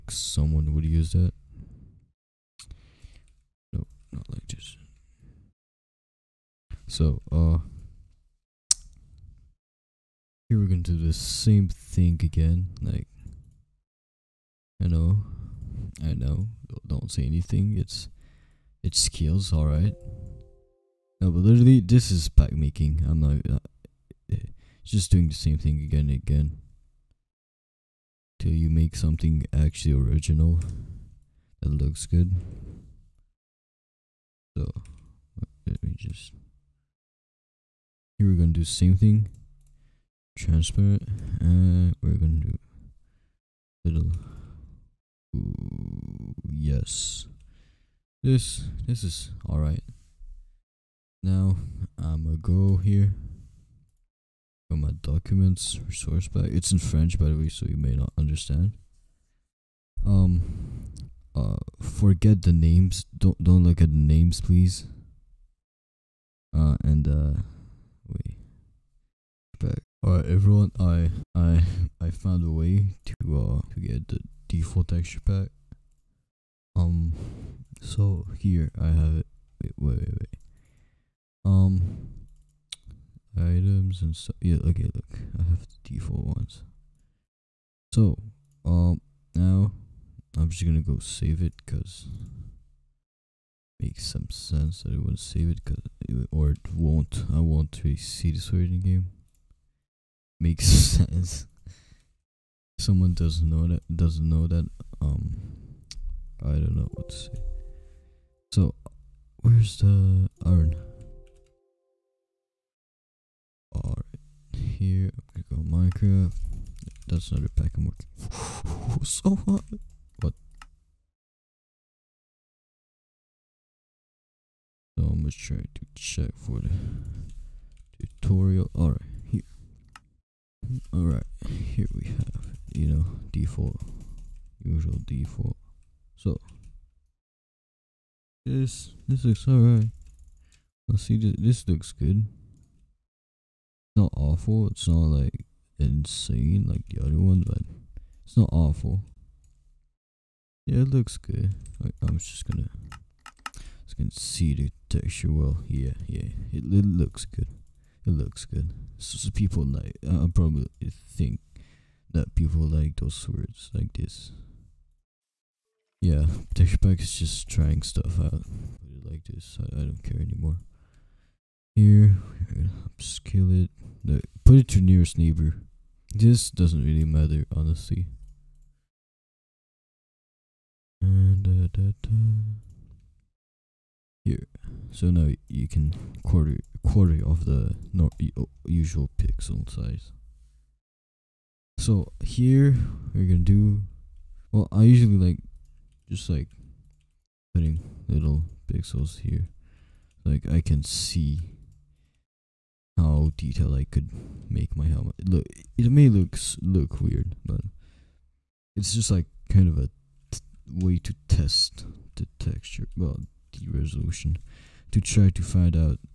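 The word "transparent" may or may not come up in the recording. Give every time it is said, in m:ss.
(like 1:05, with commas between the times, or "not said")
0:40.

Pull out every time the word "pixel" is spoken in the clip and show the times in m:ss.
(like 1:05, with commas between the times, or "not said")
3:09, 3:18.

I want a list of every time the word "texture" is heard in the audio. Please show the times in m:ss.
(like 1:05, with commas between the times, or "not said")
1:14, 2:34, 2:46, 3:32.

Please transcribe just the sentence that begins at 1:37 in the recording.
I won't really see this word in the game.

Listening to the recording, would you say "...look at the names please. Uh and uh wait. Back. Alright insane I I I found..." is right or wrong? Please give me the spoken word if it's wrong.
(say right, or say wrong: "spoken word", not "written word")
wrong: "everyone", not "insane".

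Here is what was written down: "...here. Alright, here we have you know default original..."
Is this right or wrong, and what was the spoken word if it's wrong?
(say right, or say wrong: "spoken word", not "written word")
wrong: "usual", not "original".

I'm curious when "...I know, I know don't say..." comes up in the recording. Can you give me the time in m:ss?
0:14.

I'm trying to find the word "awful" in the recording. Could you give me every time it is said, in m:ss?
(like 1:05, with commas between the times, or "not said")
2:24, 2:28.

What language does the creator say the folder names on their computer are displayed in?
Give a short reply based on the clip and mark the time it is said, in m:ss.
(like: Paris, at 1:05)
French, at 0:56.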